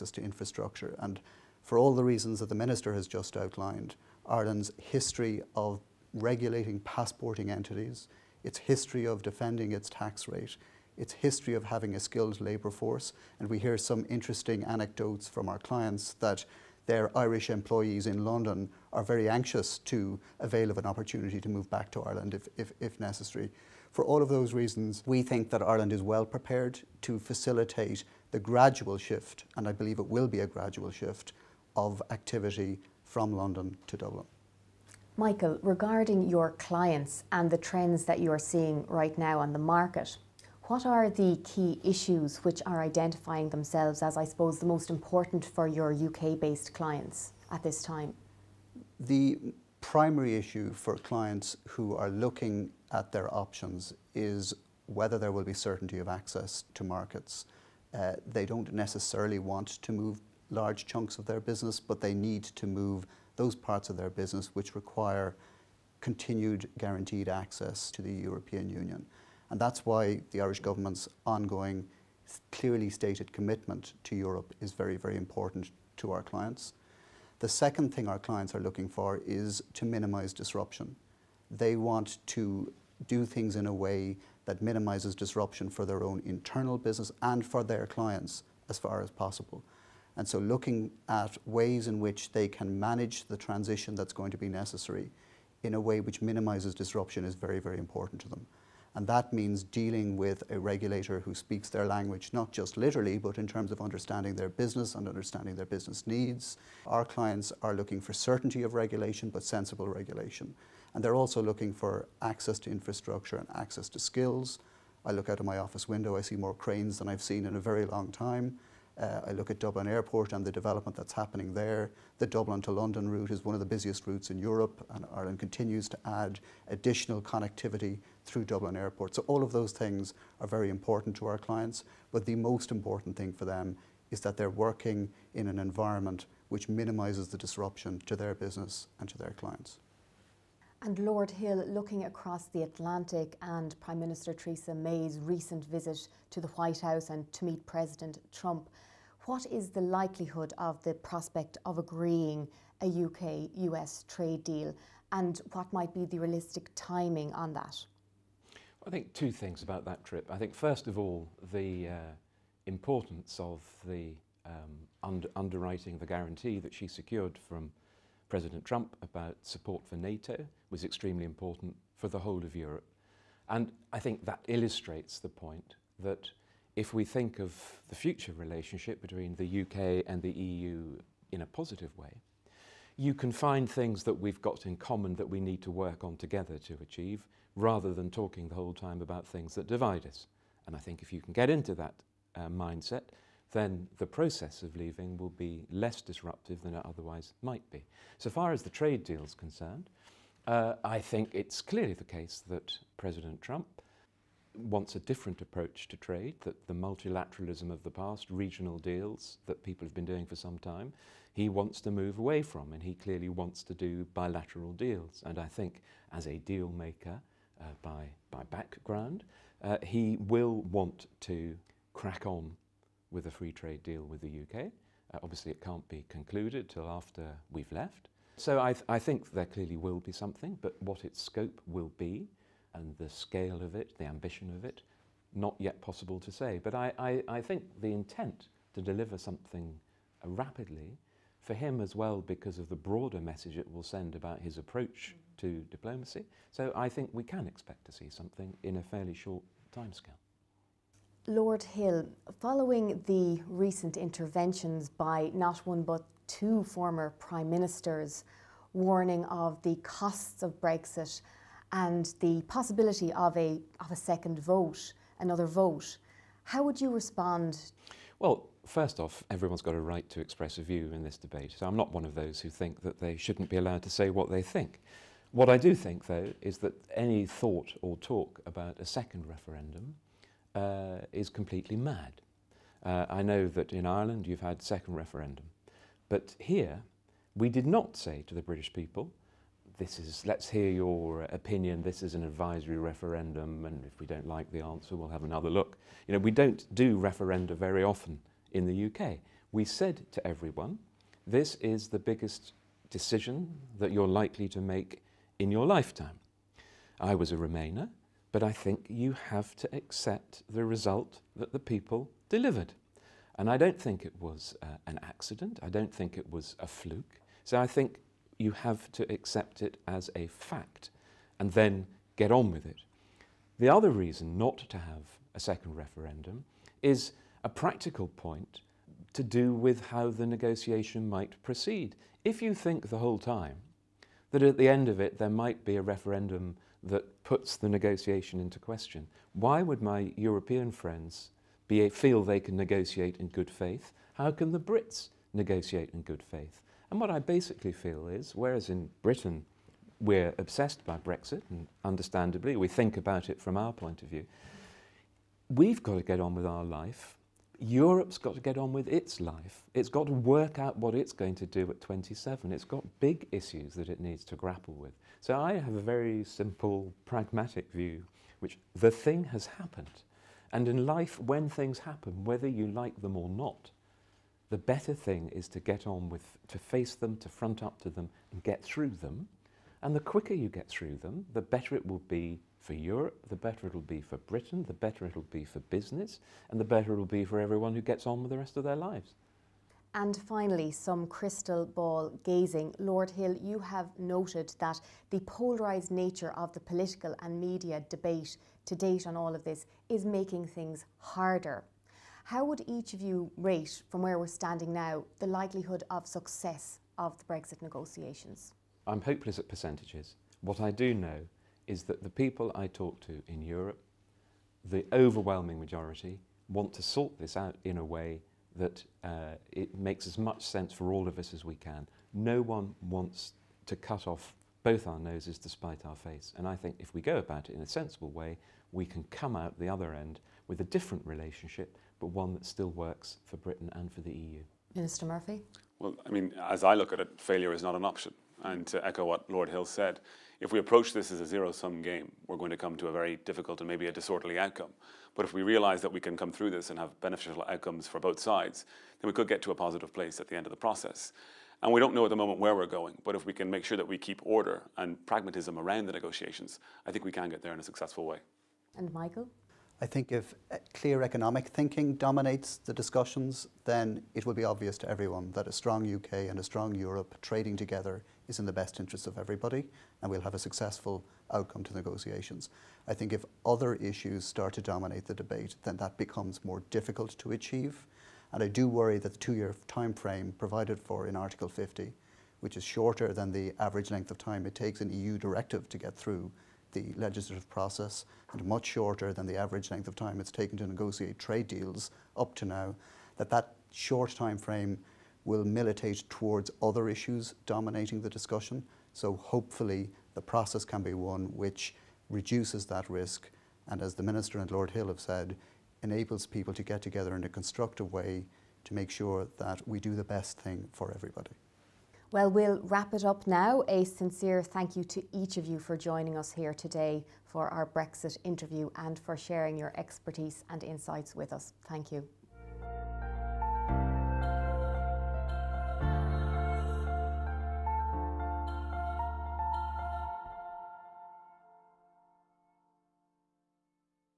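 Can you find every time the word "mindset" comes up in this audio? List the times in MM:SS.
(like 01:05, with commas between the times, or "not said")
03:12.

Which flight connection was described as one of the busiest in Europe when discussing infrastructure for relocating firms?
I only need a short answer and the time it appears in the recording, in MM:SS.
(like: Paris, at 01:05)
Dublin to London, at 02:02.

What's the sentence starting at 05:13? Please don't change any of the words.
And I don't think it was uh, an accident.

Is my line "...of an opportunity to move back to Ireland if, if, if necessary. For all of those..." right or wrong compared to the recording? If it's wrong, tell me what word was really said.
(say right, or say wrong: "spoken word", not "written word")
right.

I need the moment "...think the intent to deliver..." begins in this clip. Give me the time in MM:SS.
03:57.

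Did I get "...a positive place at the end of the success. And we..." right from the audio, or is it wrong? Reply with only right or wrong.
wrong.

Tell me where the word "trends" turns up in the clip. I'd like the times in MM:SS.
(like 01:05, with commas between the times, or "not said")
00:37.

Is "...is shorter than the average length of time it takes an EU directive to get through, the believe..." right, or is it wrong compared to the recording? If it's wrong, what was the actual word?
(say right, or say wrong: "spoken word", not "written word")
wrong: "legislative", not "believe".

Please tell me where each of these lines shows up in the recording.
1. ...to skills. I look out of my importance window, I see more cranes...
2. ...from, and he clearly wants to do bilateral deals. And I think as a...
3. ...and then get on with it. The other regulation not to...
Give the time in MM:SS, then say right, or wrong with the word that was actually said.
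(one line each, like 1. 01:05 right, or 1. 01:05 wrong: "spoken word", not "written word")
1. 01:53 wrong: "office", not "importance"
2. 03:32 right
3. 05:21 wrong: "reason", not "regulation".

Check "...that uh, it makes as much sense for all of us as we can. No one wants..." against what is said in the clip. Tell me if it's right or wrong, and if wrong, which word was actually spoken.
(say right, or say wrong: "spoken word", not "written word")
right.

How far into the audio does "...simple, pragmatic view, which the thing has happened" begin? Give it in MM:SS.
06:06.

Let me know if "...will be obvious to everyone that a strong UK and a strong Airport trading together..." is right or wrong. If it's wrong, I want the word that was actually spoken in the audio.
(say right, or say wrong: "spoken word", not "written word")
wrong: "Europe", not "Airport".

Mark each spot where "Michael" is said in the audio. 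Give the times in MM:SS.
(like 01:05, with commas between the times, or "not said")
00:35, 07:38.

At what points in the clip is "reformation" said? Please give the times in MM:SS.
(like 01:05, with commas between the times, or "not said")
not said.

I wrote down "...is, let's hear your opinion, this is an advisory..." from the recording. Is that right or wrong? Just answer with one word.
right.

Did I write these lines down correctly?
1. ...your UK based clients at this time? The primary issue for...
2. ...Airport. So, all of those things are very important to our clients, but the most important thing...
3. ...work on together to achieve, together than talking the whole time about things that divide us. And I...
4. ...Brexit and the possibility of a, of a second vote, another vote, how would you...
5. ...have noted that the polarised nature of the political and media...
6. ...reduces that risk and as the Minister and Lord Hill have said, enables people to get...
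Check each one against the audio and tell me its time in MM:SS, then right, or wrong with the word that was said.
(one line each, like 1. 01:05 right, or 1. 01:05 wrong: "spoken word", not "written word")
1. 00:45 right
2. 02:08 right
3. 03:05 wrong: "rather", not "together"
4. 04:20 right
5. 06:33 right
6. 08:22 right.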